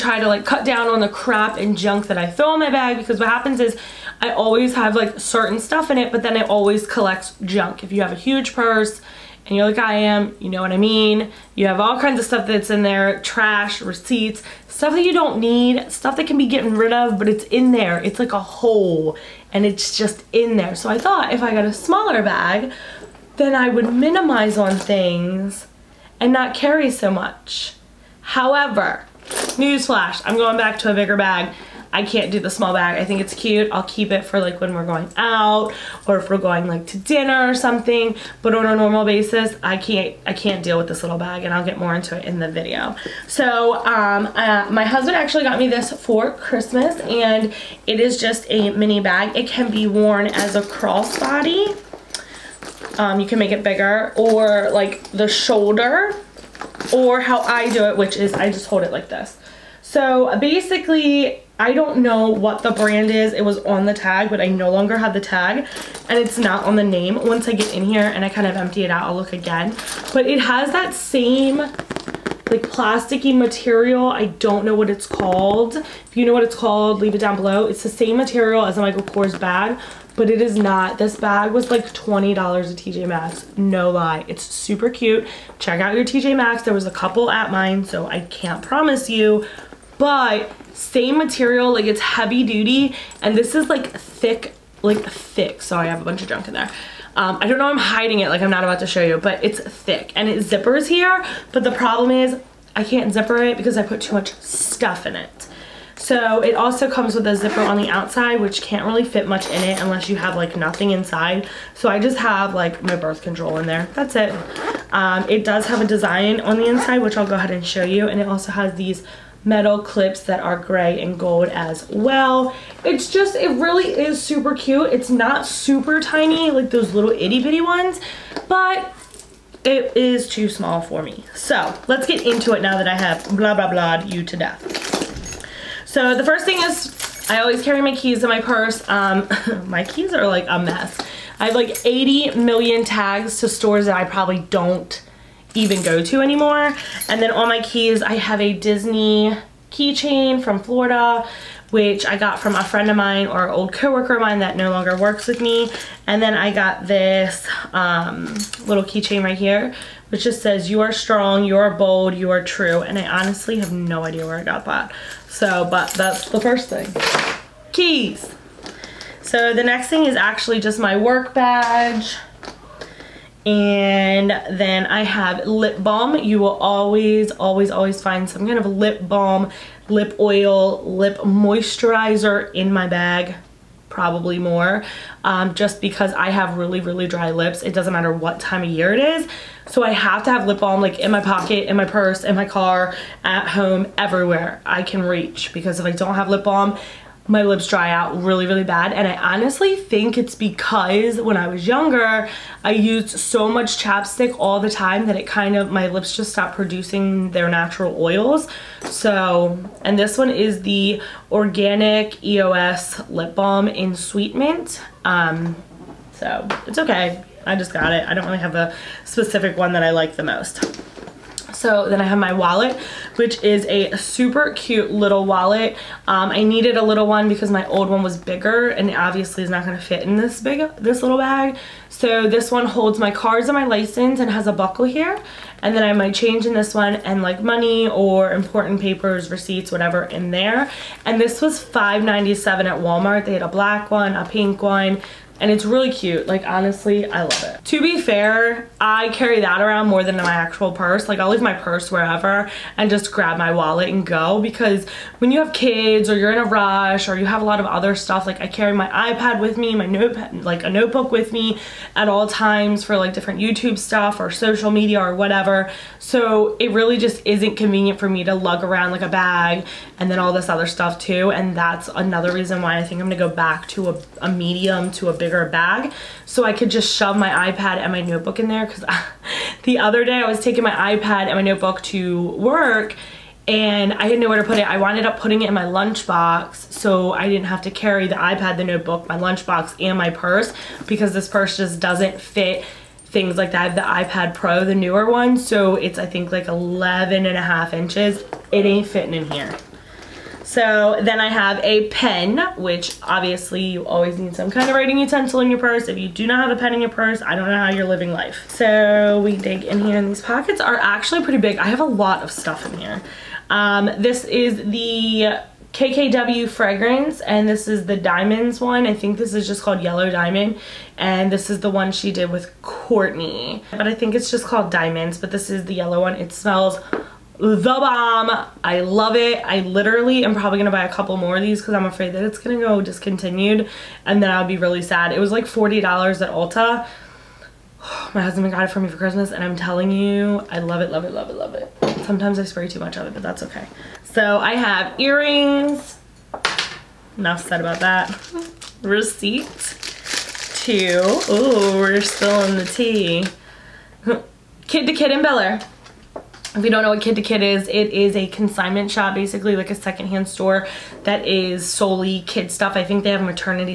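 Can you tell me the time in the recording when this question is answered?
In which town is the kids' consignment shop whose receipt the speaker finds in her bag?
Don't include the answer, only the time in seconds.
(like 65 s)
355 s.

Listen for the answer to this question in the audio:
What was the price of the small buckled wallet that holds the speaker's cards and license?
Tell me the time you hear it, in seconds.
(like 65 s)
241 s.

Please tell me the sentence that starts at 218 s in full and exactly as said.
I don't really have a specific one that I like the most.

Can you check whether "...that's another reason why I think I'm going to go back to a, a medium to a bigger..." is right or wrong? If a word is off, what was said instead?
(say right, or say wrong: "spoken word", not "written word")
right.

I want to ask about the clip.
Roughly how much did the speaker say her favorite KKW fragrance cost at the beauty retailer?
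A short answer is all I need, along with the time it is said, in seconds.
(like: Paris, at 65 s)
$40, at 335 s.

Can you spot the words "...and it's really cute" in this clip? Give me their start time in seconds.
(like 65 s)
245 s.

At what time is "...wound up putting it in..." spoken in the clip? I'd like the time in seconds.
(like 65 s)
284 s.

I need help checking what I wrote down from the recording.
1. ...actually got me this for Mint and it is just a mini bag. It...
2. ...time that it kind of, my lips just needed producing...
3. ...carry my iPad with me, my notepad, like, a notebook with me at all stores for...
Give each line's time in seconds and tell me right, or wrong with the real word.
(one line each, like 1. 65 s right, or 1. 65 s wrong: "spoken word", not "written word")
1. 45 s wrong: "Christmas", not "Mint"
2. 204 s wrong: "stopped", not "needed"
3. 258 s wrong: "times", not "stores".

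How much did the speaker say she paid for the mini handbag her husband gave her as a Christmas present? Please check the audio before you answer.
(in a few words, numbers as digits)
$20.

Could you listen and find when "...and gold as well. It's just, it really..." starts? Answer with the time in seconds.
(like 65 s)
121 s.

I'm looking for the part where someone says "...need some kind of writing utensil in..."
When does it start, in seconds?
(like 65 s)
304 s.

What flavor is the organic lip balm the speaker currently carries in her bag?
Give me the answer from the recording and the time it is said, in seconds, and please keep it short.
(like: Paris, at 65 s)
Sweet Mint, at 213 s.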